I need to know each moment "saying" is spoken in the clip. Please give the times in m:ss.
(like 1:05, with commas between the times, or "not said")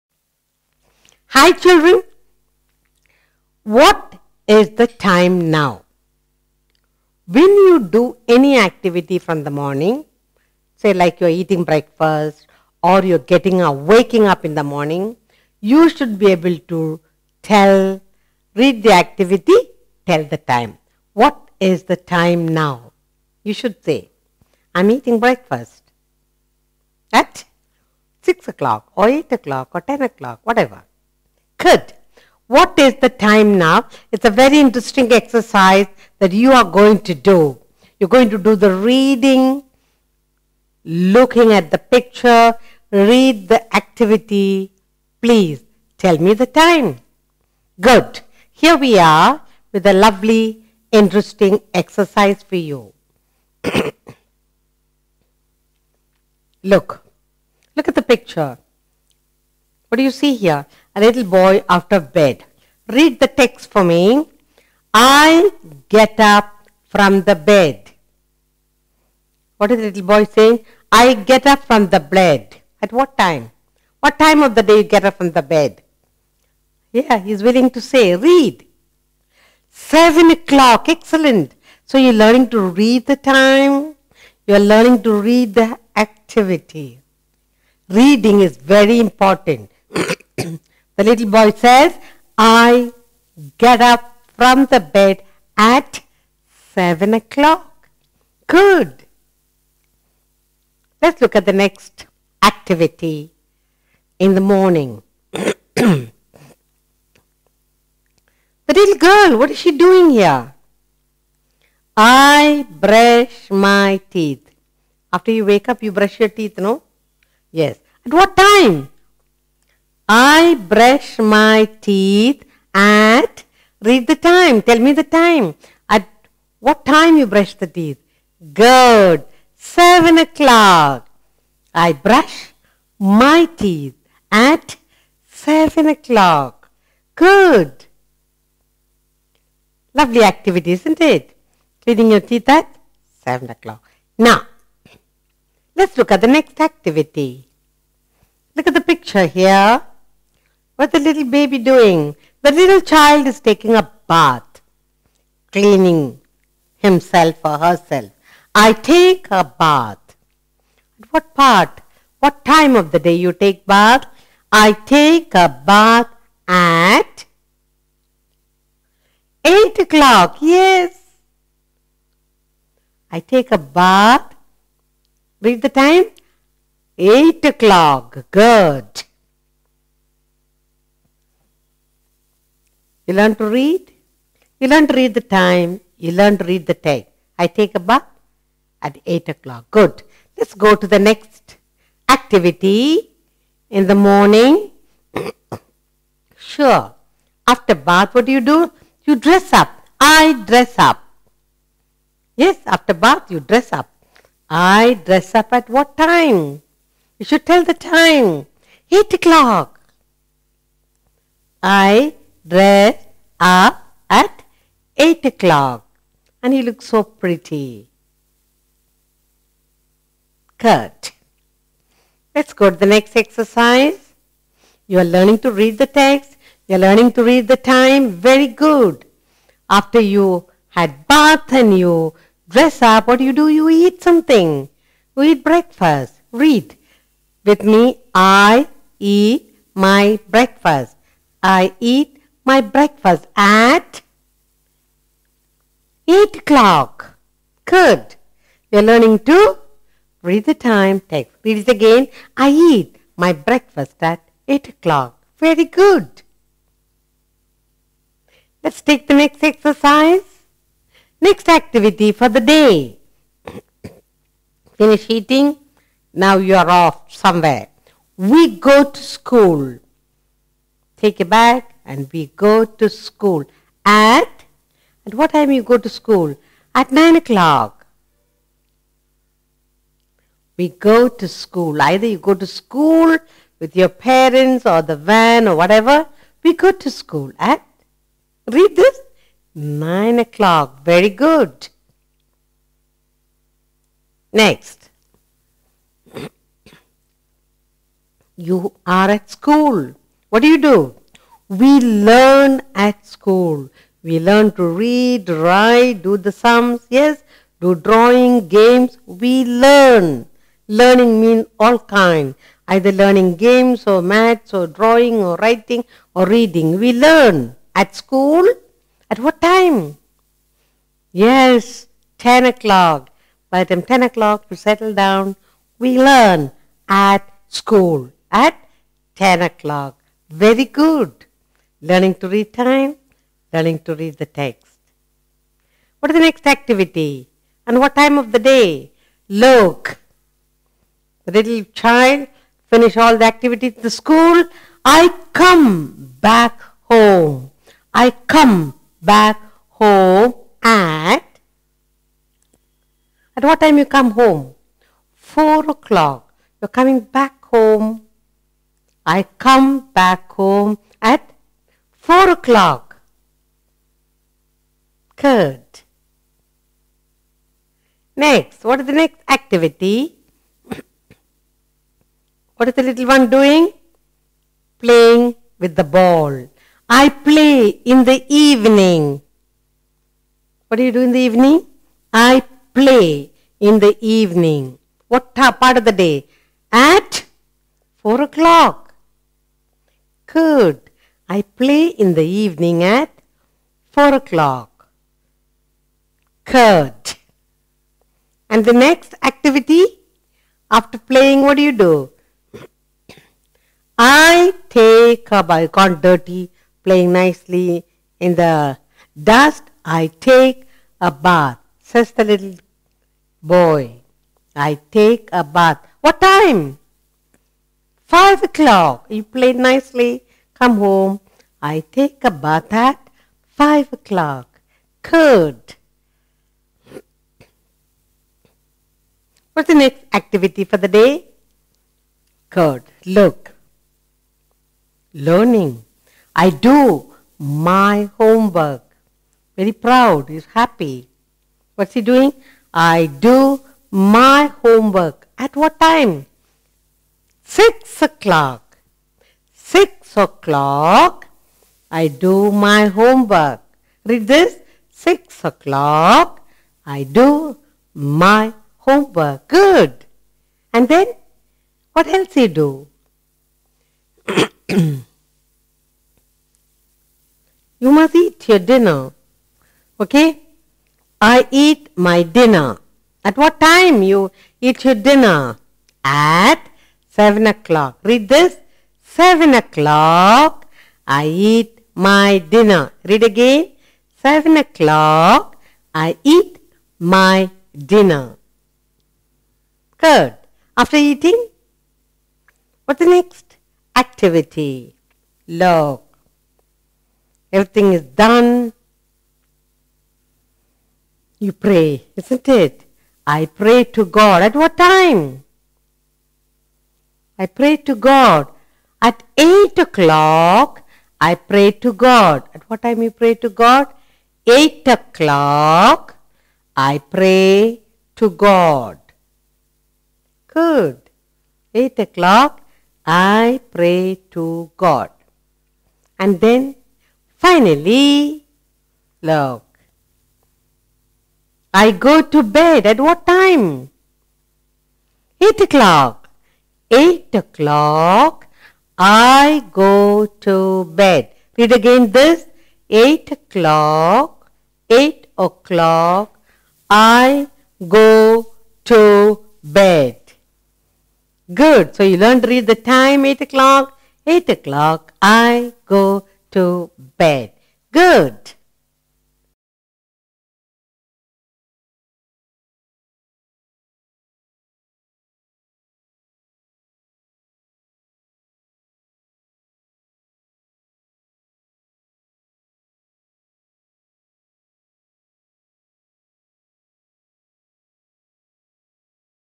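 1:10.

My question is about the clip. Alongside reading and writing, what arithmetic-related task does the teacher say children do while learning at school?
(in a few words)
sums.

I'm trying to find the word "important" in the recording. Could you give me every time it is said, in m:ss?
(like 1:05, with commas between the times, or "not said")
1:28.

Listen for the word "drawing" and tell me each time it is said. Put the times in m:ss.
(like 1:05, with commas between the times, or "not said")
5:07, 5:14.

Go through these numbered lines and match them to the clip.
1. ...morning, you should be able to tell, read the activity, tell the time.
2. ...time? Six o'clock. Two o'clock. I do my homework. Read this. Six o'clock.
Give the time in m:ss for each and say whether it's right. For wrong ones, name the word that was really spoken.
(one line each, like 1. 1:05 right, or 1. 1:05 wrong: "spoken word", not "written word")
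1. 0:14 right
2. 7:25 wrong: "Six", not "Two".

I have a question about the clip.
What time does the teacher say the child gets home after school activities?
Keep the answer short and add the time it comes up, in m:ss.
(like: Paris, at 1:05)
4 o'clock, at 5:55.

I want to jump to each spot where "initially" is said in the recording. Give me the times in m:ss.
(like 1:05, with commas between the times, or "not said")
not said.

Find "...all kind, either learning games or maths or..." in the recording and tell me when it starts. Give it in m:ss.
5:11.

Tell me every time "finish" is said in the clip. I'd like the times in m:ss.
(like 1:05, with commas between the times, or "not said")
4:24, 5:42.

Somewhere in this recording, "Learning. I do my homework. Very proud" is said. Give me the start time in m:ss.
7:15.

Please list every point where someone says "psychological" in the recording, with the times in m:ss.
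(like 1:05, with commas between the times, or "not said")
not said.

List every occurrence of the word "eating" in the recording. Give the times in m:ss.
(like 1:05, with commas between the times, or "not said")
0:11, 0:24, 4:25, 8:10.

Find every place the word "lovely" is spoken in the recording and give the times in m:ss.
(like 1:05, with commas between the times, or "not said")
0:49, 2:19.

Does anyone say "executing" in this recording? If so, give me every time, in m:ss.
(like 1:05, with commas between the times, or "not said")
not said.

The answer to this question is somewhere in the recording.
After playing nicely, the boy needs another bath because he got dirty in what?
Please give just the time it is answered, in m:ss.
6:48.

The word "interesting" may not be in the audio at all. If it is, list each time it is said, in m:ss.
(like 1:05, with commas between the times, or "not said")
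0:34, 0:50.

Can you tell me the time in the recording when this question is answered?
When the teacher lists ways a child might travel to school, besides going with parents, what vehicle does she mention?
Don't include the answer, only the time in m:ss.
4:44.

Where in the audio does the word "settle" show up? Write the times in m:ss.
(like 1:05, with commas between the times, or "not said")
5:24.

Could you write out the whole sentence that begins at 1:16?
Yeah, he's willing to say, read.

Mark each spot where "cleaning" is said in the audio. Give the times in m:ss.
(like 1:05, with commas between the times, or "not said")
2:21, 2:35.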